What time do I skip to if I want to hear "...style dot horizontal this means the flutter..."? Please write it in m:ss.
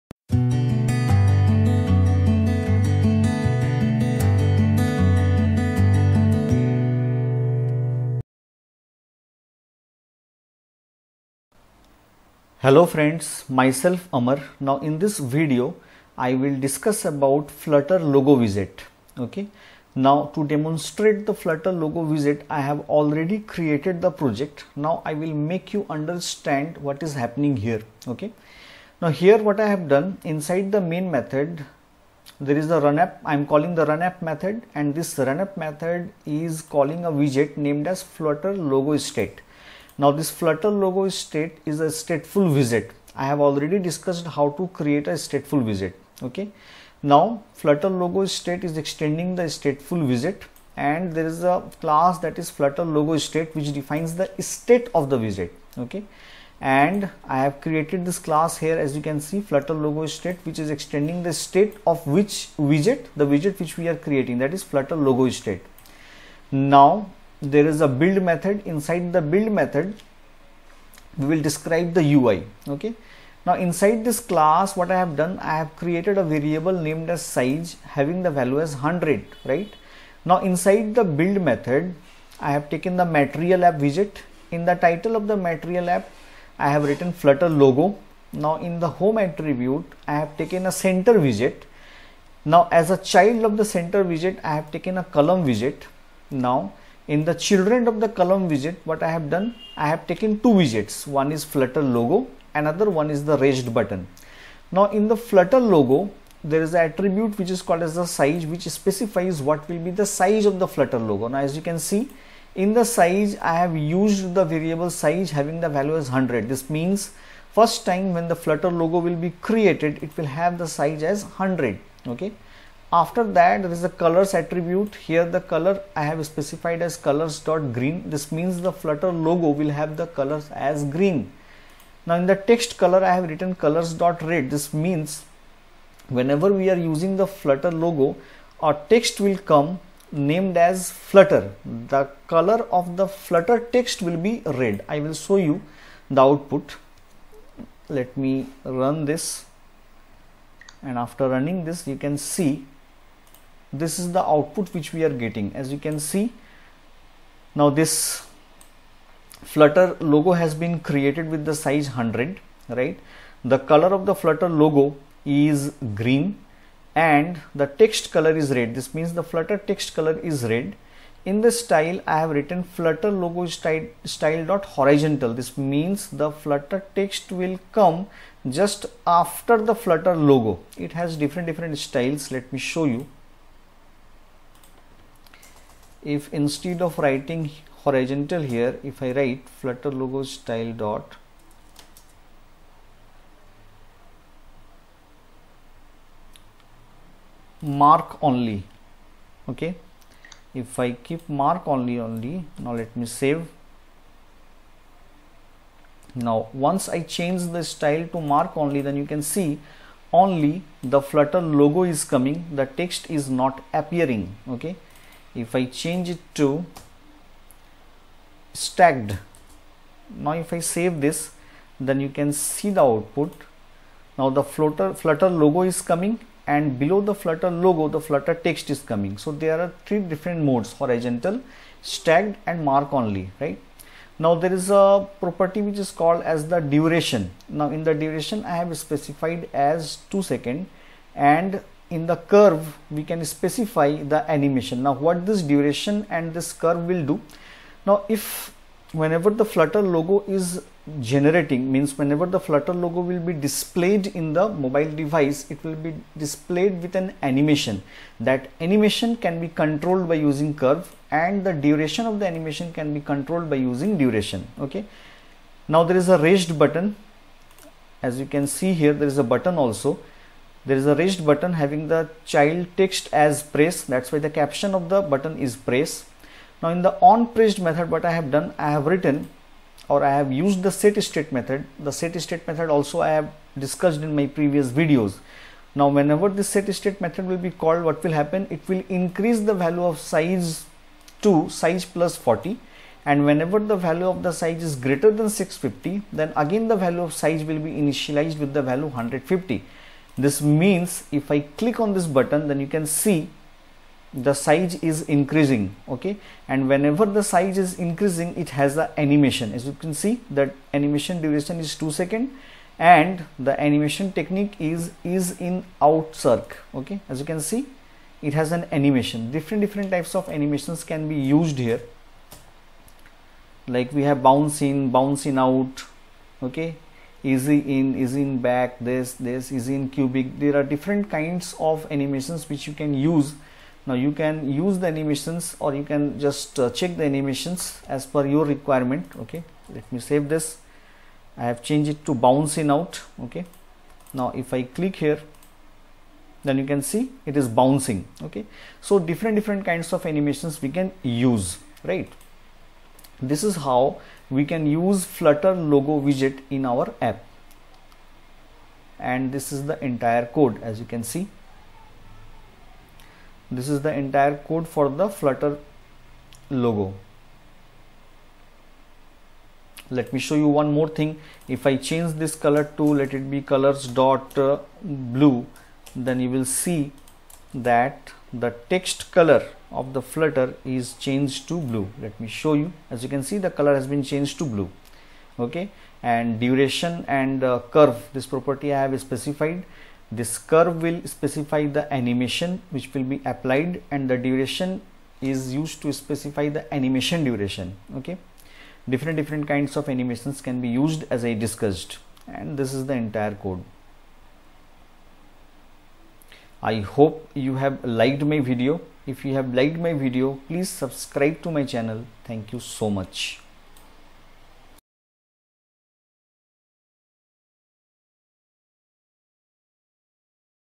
2:54.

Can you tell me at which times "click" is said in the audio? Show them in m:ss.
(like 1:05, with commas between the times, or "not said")
5:01, 5:44.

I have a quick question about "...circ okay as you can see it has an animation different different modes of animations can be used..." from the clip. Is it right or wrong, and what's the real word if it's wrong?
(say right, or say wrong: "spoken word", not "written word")
wrong: "types", not "modes".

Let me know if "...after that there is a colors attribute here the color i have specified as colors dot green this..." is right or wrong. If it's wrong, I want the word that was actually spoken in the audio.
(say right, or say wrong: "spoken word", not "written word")
right.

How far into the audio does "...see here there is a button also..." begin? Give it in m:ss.
4:28.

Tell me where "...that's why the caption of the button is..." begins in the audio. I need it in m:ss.
4:33.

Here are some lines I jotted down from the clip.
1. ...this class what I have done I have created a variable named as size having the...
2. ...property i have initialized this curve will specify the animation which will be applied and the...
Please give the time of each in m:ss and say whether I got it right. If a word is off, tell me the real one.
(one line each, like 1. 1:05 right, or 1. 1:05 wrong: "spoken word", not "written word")
1. 1:14 right
2. 6:28 wrong: "specified", not "initialized".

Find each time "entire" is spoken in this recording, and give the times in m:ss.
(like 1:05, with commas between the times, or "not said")
5:59, 6:04, 6:42.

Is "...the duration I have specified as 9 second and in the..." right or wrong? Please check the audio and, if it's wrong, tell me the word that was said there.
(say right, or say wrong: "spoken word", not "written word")
wrong: "2", not "9".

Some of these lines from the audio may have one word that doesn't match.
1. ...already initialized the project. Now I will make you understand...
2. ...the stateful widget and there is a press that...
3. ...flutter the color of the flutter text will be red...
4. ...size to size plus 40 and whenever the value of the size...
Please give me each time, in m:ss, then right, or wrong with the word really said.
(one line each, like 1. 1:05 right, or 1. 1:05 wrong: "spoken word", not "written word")
1. 0:22 wrong: "created", not "initialized"
2. 0:49 wrong: "class", not "press"
3. 2:20 right
4. 4:49 right.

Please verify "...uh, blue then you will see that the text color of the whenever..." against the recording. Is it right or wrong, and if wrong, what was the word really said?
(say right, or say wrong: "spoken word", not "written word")
wrong: "flutter", not "whenever".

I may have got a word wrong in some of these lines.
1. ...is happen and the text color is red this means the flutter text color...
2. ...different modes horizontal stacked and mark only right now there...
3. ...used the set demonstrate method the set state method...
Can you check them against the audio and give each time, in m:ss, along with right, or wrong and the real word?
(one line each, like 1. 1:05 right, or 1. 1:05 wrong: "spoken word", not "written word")
1. 2:45 wrong: "green", not "happen"
2. 3:49 right
3. 4:40 wrong: "state", not "demonstrate".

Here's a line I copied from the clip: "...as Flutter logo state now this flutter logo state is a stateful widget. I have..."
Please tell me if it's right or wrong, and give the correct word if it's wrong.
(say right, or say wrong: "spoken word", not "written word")
right.